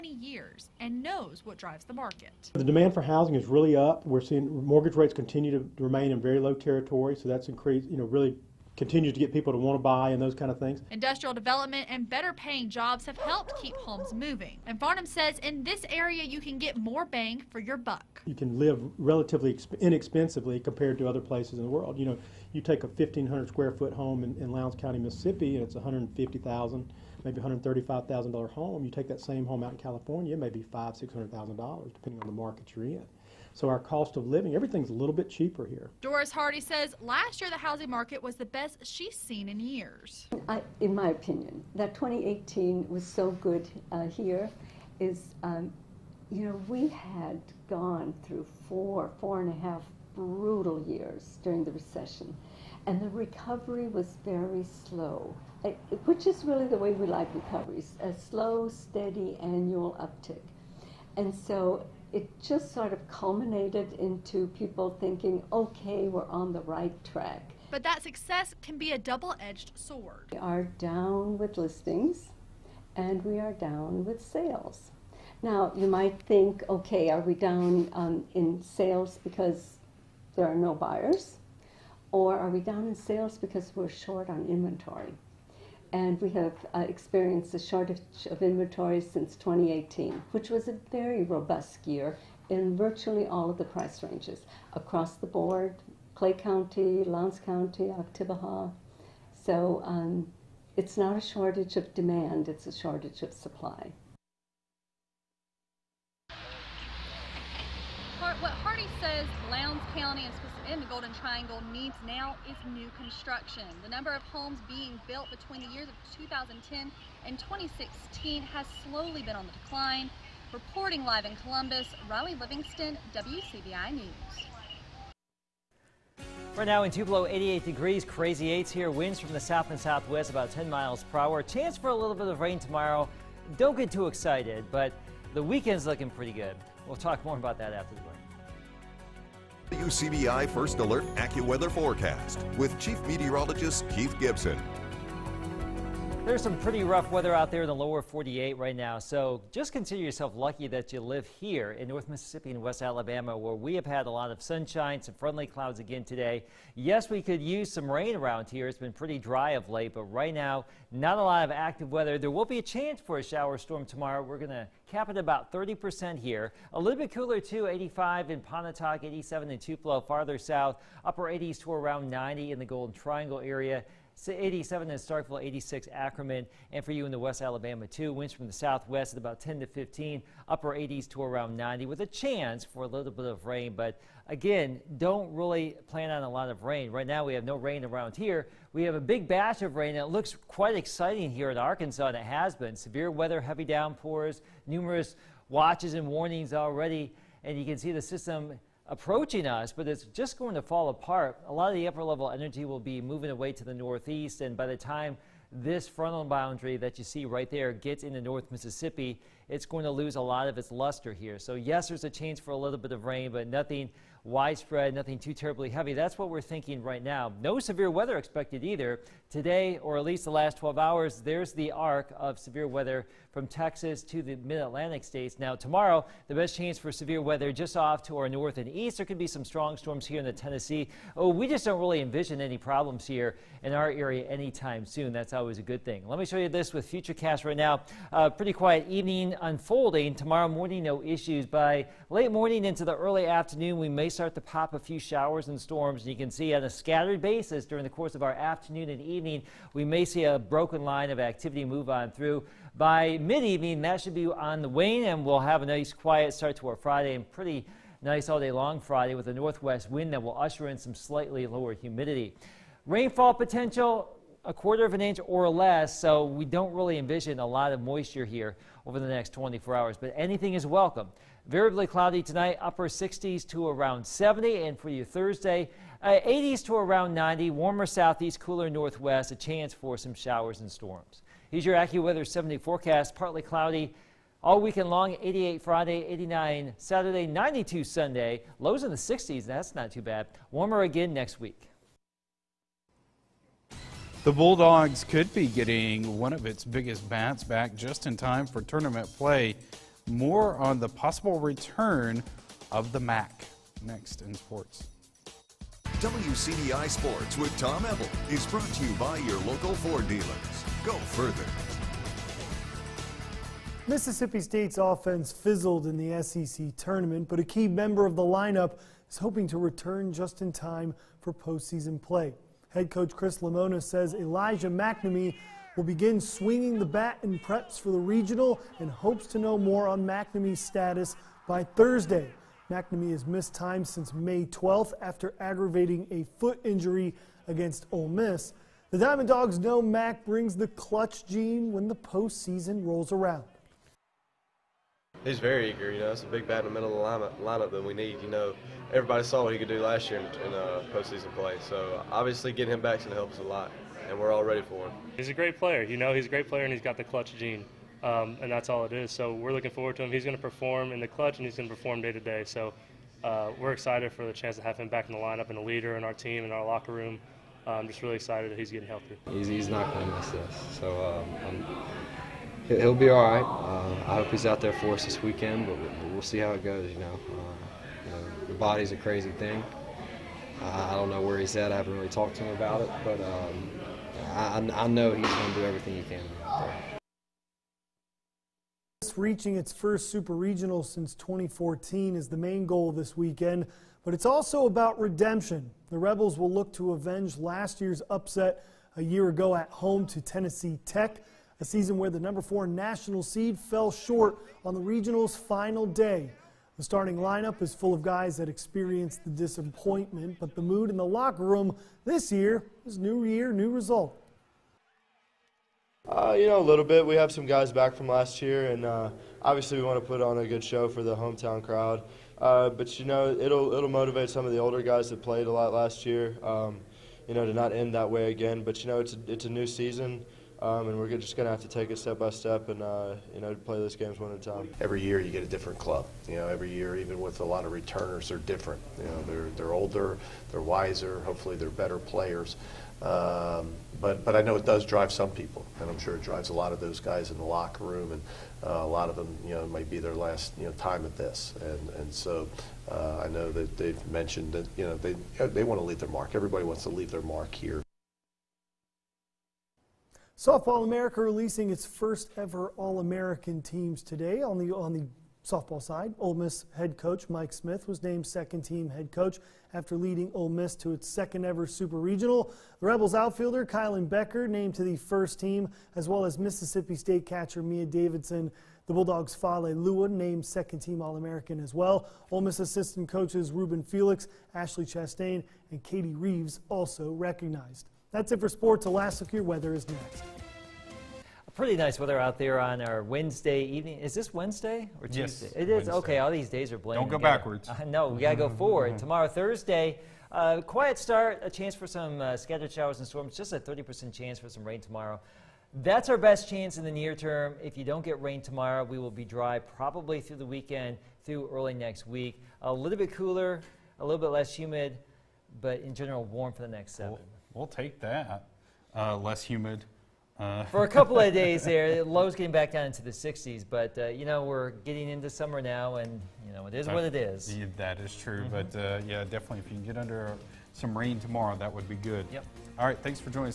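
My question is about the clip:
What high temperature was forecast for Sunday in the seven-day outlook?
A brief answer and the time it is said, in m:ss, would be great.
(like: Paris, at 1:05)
92, at 4:47.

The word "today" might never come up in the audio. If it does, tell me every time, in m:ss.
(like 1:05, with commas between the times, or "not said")
2:36, 3:39, 7:44.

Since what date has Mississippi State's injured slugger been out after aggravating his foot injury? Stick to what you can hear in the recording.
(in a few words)
May 12.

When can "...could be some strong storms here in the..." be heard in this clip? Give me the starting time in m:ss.
3:49.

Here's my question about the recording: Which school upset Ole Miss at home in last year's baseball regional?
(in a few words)
Tennessee Tech.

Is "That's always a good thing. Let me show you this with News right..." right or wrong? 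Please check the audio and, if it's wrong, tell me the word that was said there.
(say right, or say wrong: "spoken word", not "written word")
wrong: "Futurecast", not "News".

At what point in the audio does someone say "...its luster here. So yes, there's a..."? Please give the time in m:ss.
3:30.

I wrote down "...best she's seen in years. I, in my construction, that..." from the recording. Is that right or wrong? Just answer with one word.
wrong.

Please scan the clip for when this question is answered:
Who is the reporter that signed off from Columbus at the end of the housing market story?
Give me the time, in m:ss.
2:02.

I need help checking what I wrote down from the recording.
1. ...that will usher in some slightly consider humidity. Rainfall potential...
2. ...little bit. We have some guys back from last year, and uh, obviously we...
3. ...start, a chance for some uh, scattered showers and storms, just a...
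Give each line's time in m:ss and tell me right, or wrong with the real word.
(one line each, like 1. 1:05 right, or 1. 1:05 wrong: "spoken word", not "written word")
1. 4:20 wrong: "lower", not "consider"
2. 6:56 right
3. 8:20 right.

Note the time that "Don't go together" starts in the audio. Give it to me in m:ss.
8:17.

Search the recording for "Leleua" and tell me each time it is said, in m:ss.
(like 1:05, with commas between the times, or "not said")
7:59.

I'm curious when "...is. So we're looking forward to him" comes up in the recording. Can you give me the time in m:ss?
5:58.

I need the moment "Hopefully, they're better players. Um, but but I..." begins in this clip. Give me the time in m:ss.
7:21.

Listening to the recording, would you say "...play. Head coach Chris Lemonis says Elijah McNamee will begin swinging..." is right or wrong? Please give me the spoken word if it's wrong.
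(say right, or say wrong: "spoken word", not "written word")
right.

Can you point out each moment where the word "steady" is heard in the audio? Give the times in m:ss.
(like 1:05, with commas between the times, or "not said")
0:58.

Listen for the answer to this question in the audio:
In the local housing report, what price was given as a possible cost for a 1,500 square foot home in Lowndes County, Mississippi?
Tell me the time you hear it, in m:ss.
0:27.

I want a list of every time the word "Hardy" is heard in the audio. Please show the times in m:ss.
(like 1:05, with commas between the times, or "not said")
0:36, 1:48.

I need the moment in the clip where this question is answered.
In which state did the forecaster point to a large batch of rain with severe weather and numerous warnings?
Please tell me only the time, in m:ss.
3:11.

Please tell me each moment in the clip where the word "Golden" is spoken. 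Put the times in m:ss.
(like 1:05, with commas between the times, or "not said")
1:50, 2:52.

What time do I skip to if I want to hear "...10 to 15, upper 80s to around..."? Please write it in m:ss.
2:59.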